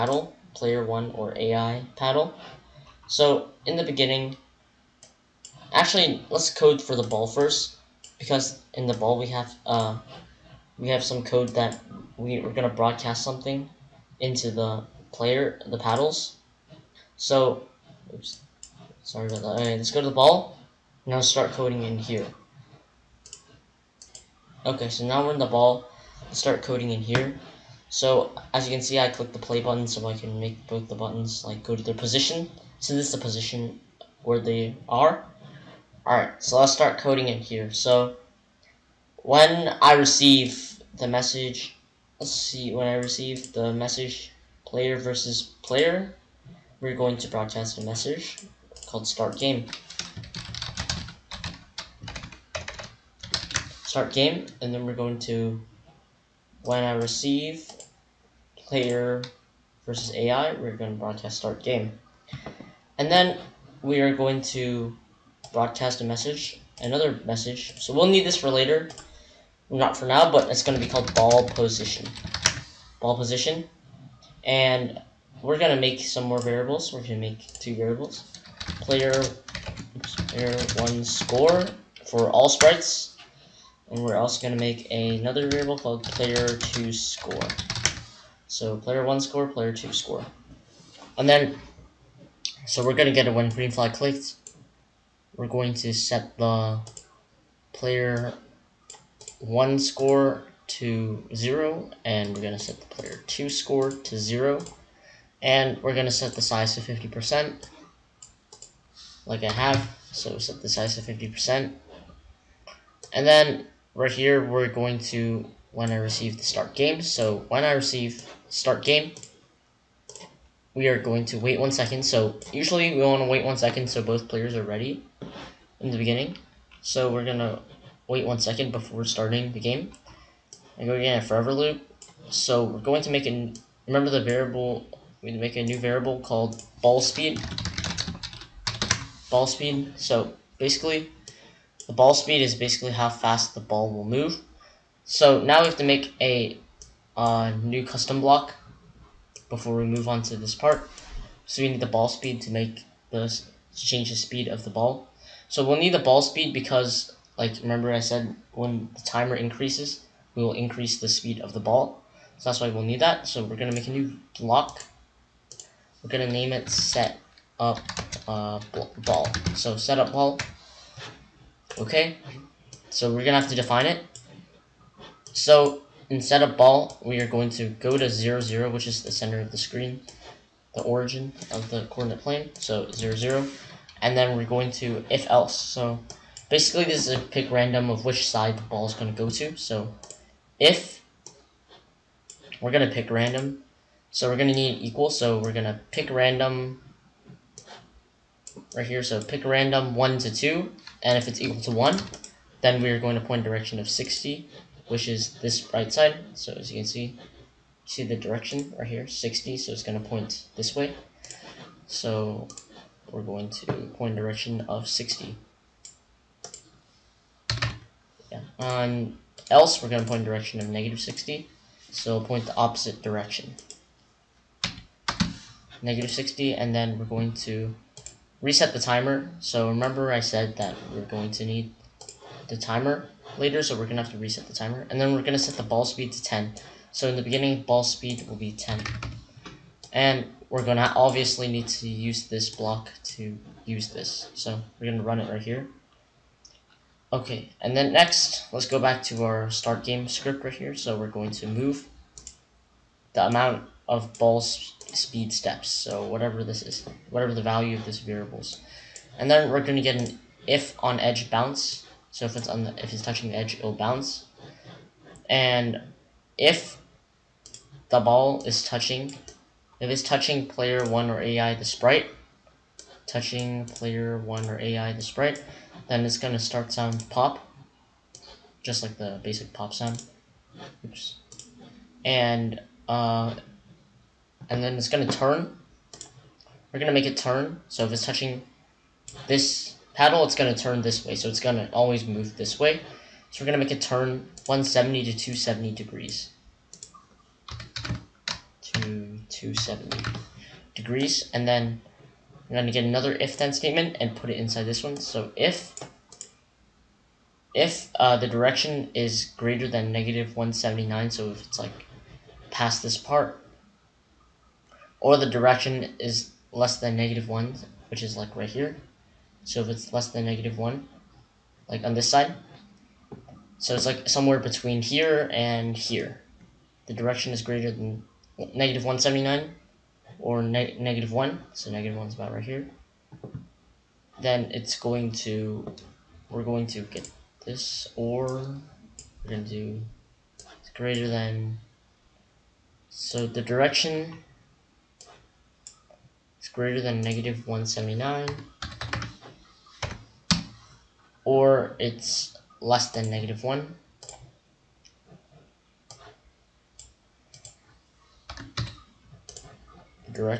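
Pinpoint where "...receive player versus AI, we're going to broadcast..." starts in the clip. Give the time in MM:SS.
00:56.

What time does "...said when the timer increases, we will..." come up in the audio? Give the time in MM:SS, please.
02:37.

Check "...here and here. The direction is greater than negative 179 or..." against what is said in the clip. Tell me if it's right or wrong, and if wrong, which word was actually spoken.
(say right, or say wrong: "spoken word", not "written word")
right.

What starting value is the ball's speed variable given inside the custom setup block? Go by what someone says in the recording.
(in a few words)
10.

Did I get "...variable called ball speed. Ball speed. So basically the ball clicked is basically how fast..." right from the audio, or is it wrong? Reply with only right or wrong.
wrong.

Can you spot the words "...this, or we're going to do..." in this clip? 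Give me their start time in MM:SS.
05:37.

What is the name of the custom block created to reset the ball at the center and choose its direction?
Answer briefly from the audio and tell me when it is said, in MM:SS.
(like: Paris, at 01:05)
set up ball, at 02:46.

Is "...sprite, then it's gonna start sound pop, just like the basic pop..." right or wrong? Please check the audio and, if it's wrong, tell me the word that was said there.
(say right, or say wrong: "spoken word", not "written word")
right.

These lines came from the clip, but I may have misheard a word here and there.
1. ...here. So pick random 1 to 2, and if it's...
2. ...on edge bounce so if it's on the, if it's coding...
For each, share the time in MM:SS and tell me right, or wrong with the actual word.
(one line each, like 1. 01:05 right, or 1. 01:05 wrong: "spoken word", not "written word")
1. 03:18 right
2. 04:20 wrong: "touching", not "coding".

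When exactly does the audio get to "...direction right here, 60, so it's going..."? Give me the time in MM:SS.
03:28.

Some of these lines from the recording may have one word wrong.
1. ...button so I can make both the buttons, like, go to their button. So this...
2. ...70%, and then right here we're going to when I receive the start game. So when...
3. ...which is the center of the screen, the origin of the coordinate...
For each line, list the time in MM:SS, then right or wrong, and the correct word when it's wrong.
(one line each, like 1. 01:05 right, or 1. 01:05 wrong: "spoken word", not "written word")
1. 00:29 wrong: "position", not "button"
2. 01:51 wrong: "50", not "70"
3. 02:58 right.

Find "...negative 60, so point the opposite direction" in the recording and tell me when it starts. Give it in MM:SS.
03:40.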